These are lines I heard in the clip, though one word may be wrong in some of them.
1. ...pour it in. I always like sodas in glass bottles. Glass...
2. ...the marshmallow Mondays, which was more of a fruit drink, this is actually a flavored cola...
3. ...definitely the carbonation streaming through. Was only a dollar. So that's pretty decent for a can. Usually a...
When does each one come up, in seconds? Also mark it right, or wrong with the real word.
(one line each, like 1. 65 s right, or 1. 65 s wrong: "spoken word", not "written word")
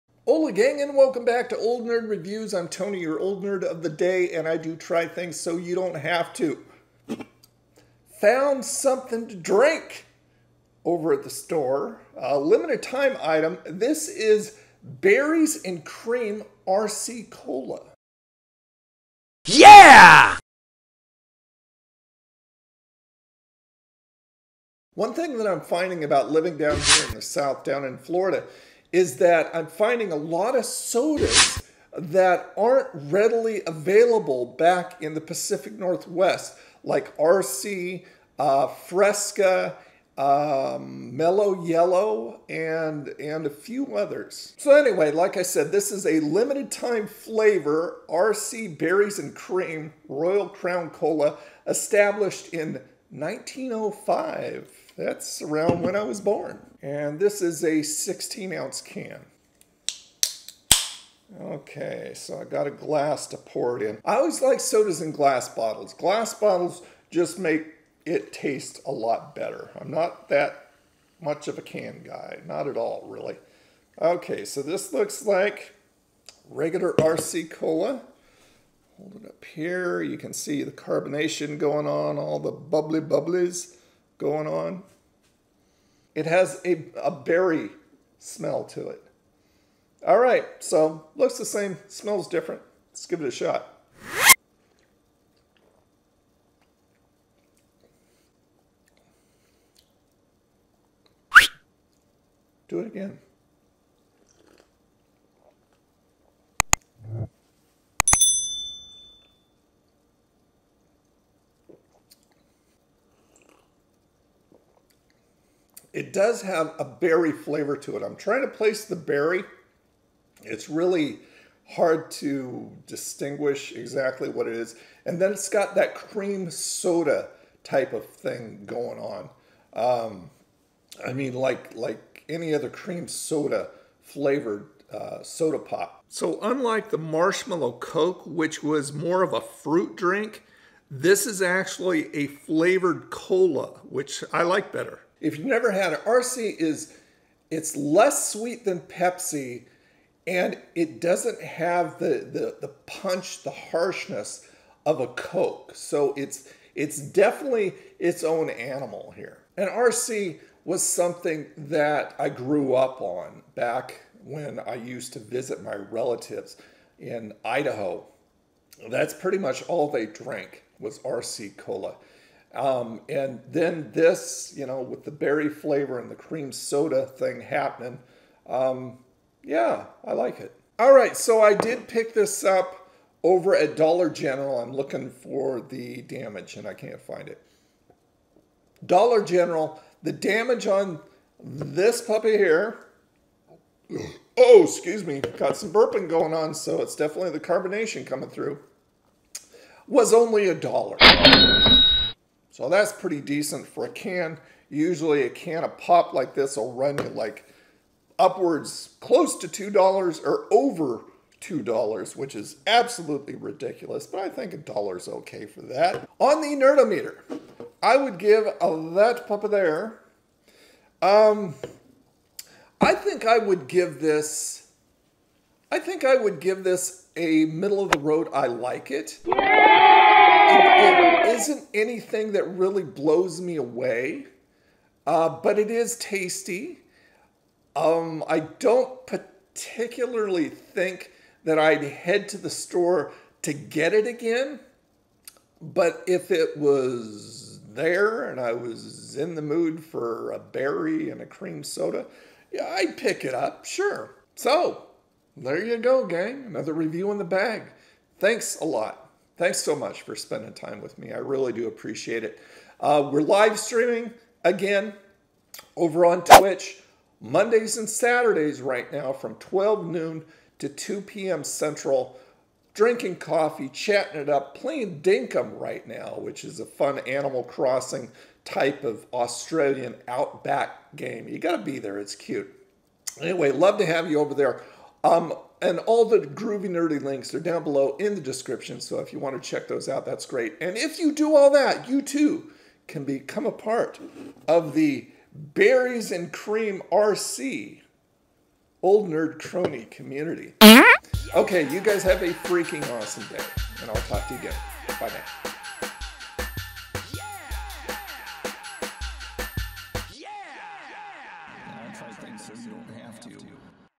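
1. 63 s right
2. 136 s wrong: "Coke", not "Mondays"
3. 196 s wrong: "coming", not "streaming".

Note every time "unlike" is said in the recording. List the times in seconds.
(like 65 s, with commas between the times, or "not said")
136 s.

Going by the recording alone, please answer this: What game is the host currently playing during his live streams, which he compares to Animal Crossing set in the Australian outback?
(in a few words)
Dinkum.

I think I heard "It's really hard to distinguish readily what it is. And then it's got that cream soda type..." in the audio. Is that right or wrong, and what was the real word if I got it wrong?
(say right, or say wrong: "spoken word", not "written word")
wrong: "exactly", not "readily".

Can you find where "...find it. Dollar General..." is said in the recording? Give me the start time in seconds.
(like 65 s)
187 s.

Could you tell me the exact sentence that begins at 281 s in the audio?
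You got to be there, it's cute.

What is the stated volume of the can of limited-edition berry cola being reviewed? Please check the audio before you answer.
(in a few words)
16 ounces.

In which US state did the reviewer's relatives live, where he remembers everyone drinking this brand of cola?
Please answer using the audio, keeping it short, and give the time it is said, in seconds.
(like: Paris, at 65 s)
Idaho, at 167 s.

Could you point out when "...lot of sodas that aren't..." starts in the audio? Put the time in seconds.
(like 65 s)
30 s.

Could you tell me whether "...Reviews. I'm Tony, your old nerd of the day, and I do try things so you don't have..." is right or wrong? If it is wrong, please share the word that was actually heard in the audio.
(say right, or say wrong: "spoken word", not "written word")
right.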